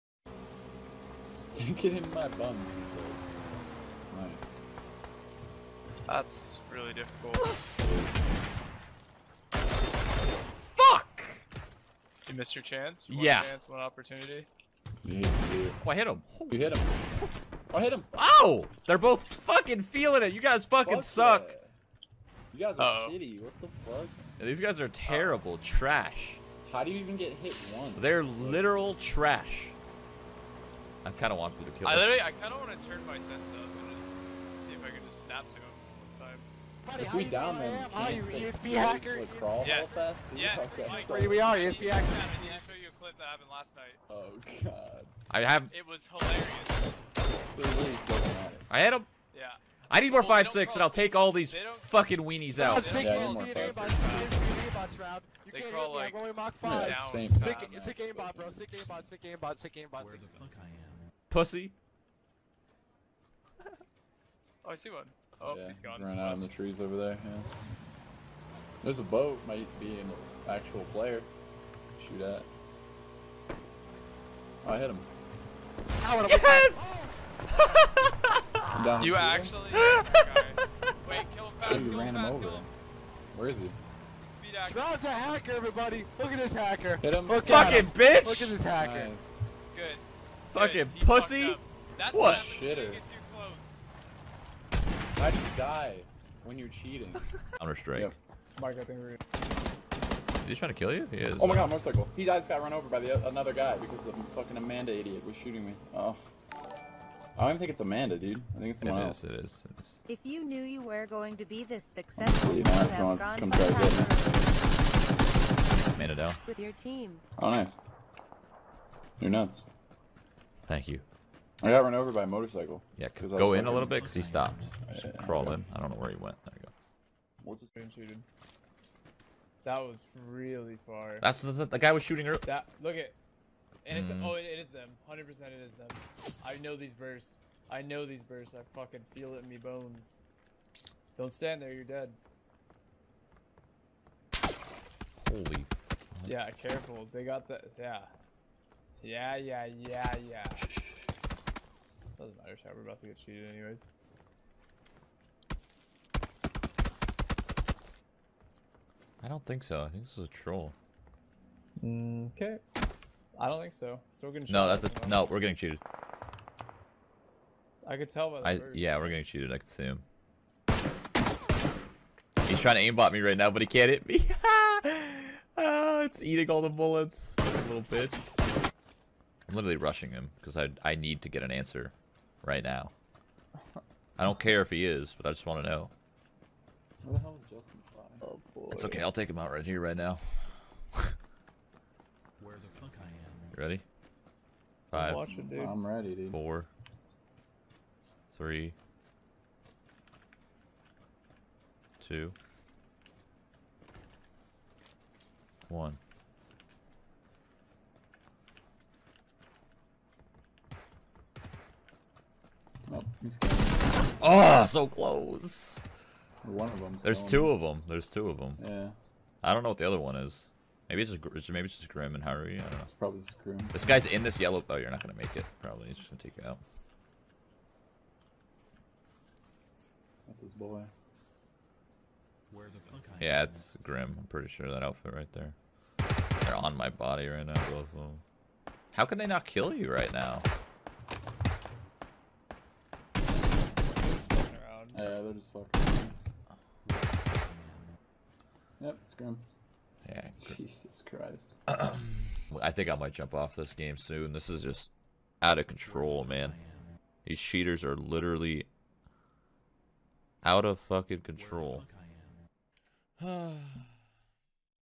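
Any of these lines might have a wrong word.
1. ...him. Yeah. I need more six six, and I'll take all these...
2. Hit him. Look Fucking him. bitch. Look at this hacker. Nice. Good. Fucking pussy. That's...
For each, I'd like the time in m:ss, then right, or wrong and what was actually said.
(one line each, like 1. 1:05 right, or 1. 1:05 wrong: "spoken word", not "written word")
1. 0:48 wrong: "five", not "six"
2. 1:26 right.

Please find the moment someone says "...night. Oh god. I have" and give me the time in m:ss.
0:43.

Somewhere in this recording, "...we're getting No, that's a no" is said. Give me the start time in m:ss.
2:44.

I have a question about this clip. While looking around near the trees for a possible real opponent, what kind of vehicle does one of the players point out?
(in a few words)
boat.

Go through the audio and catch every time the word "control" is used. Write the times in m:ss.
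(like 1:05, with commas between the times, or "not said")
4:15, 4:21.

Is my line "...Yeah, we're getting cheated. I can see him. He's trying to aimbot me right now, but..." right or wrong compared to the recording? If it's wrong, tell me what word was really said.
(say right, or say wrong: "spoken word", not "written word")
right.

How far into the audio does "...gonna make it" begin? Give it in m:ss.
3:45.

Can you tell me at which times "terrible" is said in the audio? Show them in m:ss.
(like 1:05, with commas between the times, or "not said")
0:24.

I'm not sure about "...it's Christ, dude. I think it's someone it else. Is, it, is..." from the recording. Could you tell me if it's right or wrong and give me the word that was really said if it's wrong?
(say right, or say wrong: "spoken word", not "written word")
wrong: "Amanda", not "Christ".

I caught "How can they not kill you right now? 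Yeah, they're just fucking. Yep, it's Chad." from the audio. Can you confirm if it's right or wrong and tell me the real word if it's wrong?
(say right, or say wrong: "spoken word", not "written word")
wrong: "Yeah", not "Chad".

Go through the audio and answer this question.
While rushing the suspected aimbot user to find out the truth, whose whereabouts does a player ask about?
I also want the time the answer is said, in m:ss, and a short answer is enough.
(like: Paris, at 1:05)
Justin, at 3:07.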